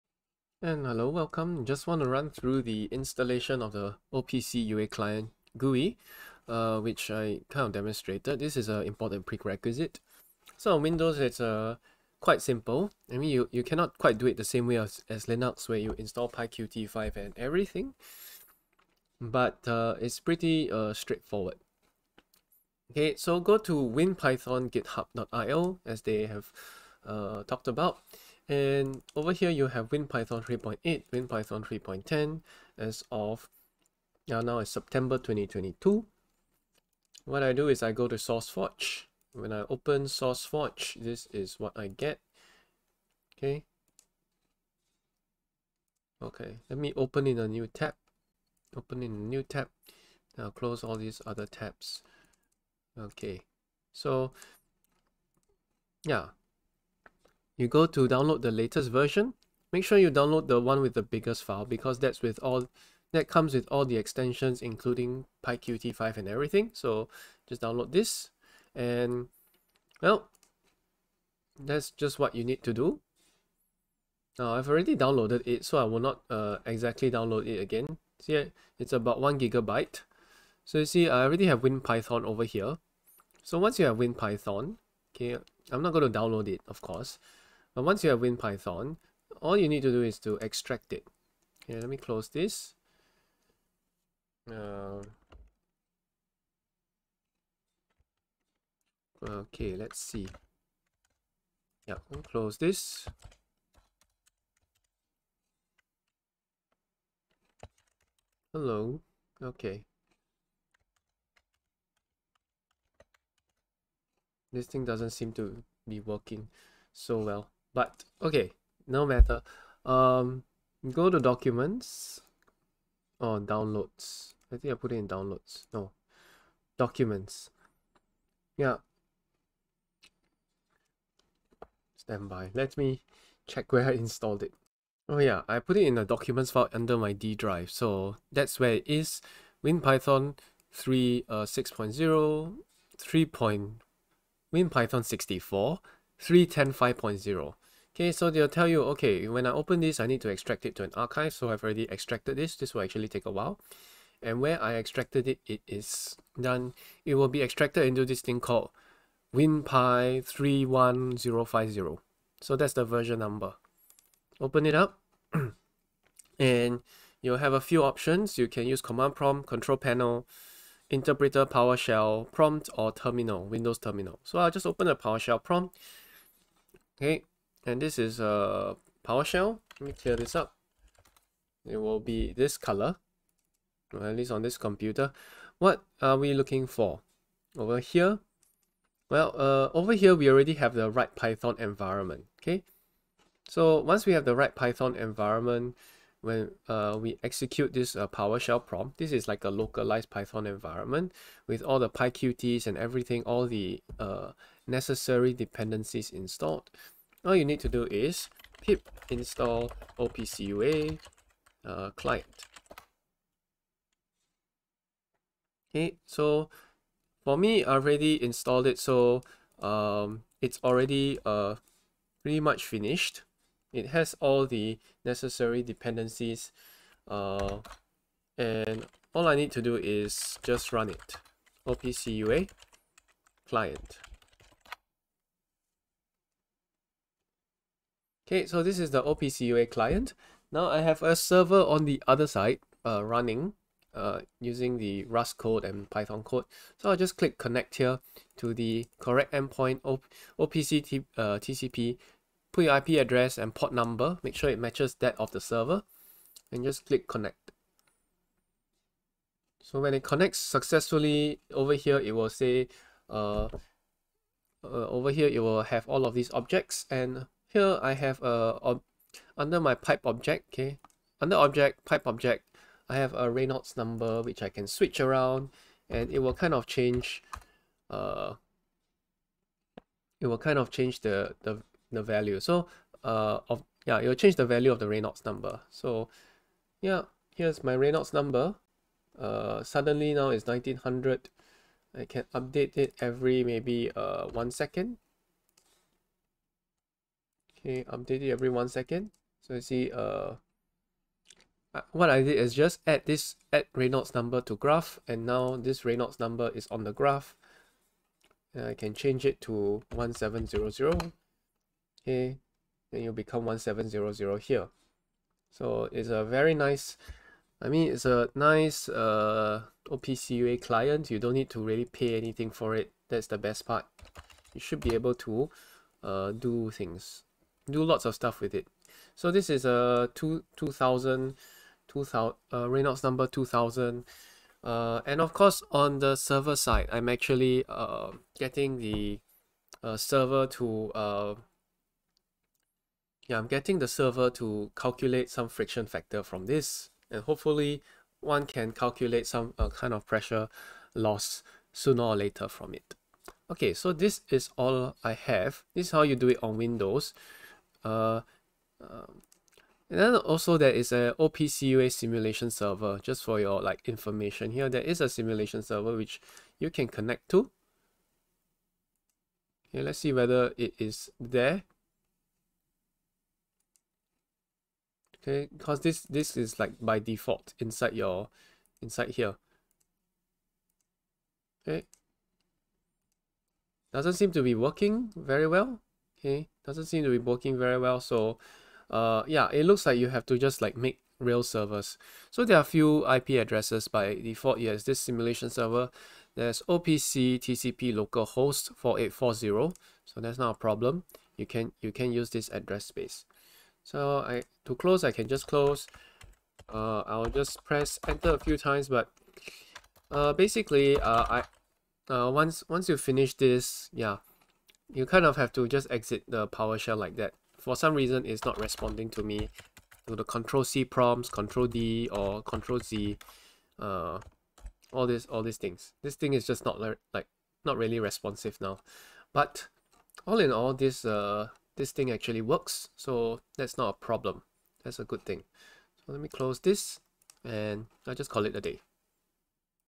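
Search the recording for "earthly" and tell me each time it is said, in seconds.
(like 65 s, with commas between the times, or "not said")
not said.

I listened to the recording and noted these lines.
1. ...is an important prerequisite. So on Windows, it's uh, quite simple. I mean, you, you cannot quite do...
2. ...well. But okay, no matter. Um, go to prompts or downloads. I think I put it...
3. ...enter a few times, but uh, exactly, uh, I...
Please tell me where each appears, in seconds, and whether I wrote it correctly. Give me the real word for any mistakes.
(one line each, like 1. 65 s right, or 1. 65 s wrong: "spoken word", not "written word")
1. 8 s right
2. 117 s wrong: "documents", not "prompts"
3. 408 s wrong: "basically", not "exactly".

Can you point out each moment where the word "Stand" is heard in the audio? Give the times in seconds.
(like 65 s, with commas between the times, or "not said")
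131 s.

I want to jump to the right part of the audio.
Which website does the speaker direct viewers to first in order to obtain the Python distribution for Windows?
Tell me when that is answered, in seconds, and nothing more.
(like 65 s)
23 s.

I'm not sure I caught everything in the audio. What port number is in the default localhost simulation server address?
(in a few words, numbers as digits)
4840.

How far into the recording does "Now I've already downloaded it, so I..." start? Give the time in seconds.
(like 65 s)
74 s.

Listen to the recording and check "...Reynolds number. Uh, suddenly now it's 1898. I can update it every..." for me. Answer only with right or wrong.
wrong.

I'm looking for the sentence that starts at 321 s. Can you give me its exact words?
You don't need to really pay anything for it.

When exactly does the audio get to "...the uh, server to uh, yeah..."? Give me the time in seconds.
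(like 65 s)
338 s.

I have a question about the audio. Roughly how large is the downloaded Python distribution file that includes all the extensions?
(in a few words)
1 gigabyte.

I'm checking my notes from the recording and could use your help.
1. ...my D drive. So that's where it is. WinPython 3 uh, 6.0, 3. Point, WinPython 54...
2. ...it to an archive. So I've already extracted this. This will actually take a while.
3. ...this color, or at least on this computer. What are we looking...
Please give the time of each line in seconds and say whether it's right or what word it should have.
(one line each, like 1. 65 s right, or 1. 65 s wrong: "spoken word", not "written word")
1. 136 s wrong: "64", not "54"
2. 150 s right
3. 182 s right.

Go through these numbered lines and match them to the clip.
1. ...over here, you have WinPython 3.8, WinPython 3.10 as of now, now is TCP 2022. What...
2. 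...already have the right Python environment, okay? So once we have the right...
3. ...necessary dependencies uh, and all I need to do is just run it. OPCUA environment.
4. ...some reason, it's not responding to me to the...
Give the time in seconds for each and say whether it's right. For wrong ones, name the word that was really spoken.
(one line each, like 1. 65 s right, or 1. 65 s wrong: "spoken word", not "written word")
1. 29 s wrong: "September", not "TCP"
2. 190 s right
3. 225 s wrong: "client", not "environment"
4. 417 s right.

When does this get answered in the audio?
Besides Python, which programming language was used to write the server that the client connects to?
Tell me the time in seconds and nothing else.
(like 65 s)
245 s.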